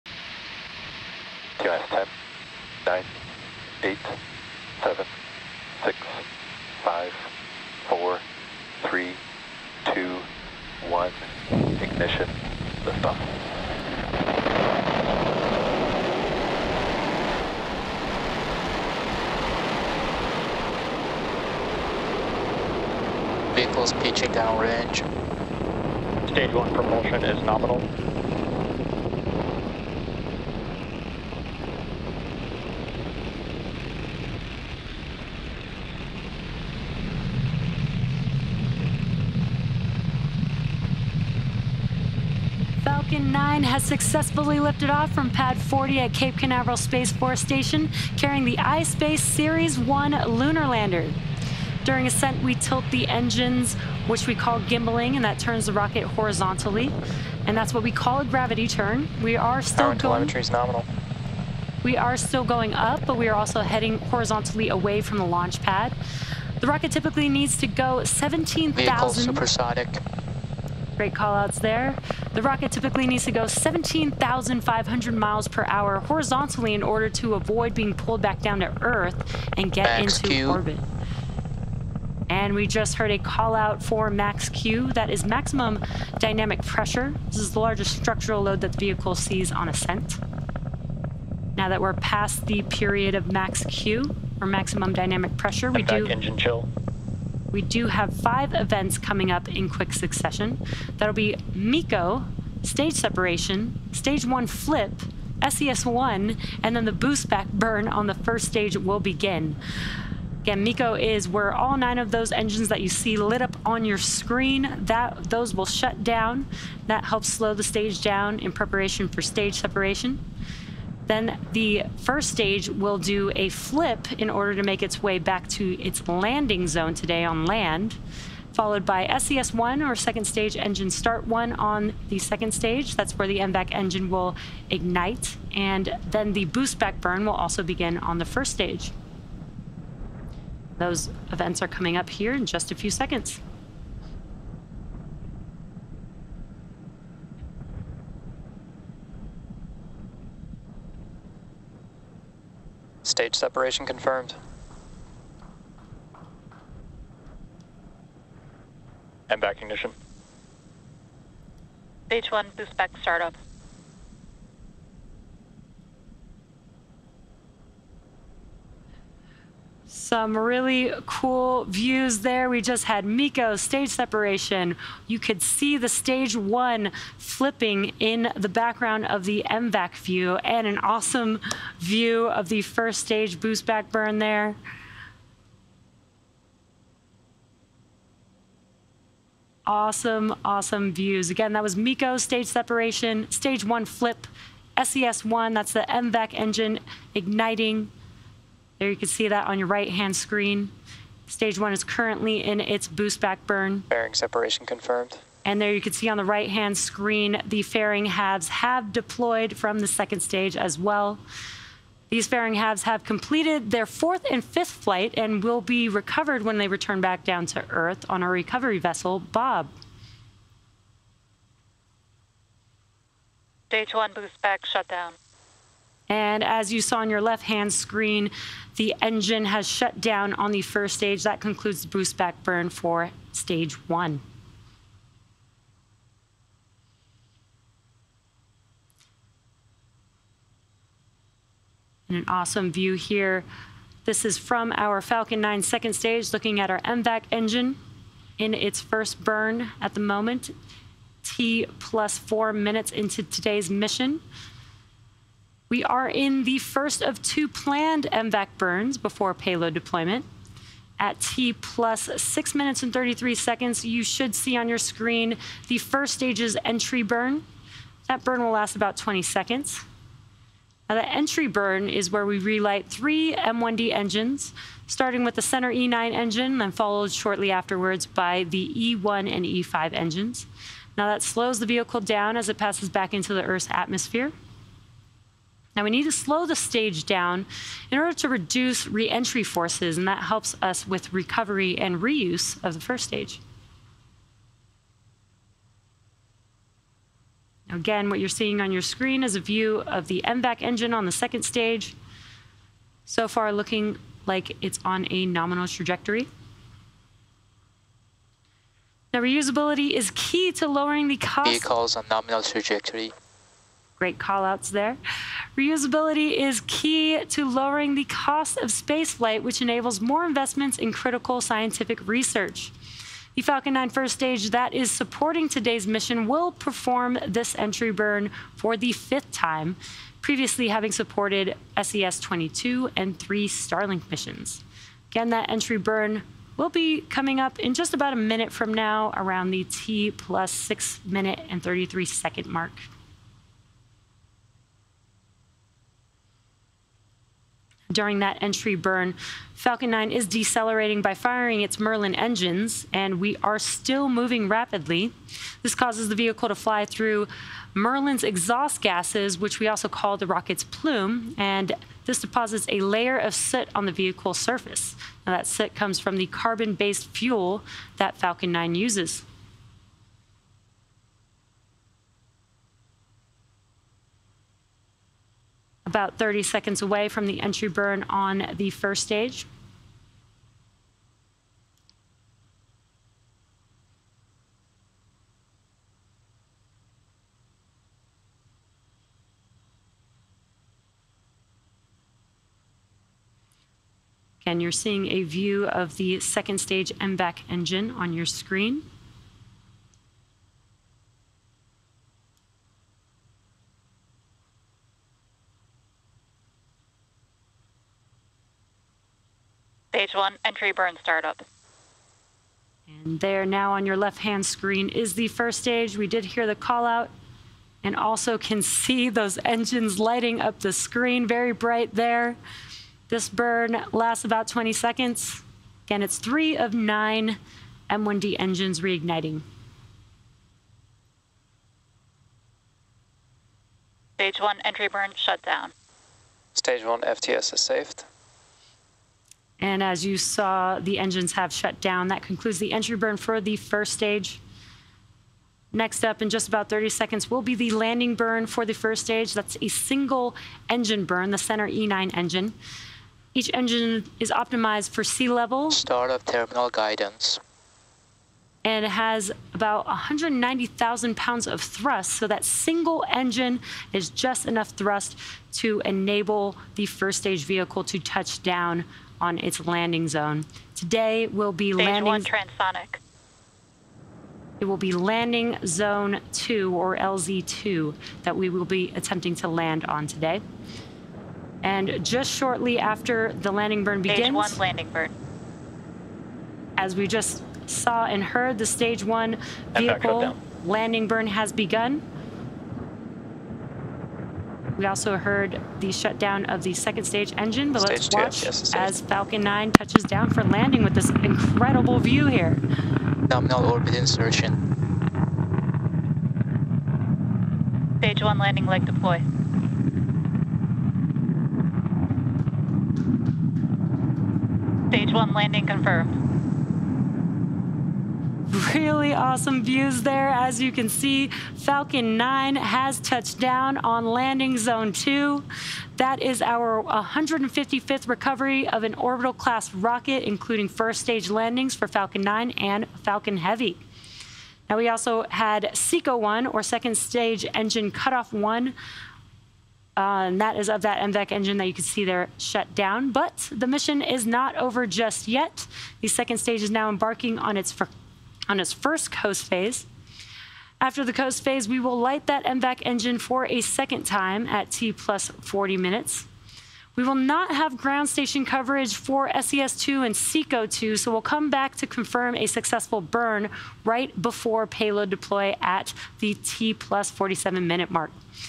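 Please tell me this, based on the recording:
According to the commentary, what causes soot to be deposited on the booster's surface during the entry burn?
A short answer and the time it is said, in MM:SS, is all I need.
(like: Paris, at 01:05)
carbon based fuel, at 06:06.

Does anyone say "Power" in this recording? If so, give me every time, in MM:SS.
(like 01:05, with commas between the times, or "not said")
00:59.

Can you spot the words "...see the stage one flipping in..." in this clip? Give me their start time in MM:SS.
02:55.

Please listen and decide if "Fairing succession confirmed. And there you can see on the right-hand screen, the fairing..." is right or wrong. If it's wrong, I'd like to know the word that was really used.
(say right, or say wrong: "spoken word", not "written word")
wrong: "separation", not "succession".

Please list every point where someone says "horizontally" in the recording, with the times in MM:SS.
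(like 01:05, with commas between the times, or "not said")
00:56, 01:03, 01:15.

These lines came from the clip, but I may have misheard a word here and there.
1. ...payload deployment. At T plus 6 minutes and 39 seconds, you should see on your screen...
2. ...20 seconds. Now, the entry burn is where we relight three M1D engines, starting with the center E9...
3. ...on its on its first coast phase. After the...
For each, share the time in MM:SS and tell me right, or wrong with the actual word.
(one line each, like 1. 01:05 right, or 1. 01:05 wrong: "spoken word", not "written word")
1. 04:19 wrong: "33", not "39"
2. 04:28 right
3. 09:07 right.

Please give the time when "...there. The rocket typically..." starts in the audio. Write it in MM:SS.
01:11.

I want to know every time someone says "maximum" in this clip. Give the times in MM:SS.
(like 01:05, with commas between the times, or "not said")
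01:25, 01:34.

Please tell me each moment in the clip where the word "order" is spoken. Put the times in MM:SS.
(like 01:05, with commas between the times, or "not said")
01:16, 02:04, 04:47.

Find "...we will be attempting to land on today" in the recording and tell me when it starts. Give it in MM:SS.
07:58.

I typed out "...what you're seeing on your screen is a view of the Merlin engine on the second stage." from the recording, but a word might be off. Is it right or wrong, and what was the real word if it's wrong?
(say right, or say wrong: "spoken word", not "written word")
wrong: "MVAC", not "Merlin".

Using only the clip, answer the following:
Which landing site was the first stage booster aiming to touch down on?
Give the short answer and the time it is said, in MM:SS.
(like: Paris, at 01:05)
Landing Zone 2, at 07:54.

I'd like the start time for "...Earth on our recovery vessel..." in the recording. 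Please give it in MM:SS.
03:37.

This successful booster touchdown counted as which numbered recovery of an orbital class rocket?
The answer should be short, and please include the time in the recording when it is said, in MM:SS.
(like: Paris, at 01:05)
155th, at 08:46.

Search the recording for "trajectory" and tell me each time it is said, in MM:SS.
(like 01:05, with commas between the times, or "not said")
05:05, 05:12.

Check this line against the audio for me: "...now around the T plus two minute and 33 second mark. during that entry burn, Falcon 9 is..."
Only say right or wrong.
wrong.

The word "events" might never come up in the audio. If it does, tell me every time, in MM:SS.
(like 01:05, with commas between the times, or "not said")
01:38, 02:21.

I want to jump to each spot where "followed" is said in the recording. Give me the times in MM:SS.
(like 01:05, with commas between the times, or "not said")
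02:08, 04:36.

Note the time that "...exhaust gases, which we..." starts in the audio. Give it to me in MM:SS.
05:58.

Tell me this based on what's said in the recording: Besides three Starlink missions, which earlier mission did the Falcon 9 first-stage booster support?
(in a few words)
SES 22.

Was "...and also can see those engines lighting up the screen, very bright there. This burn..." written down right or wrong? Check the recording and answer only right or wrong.
right.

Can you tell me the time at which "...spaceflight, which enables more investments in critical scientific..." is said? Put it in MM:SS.
05:18.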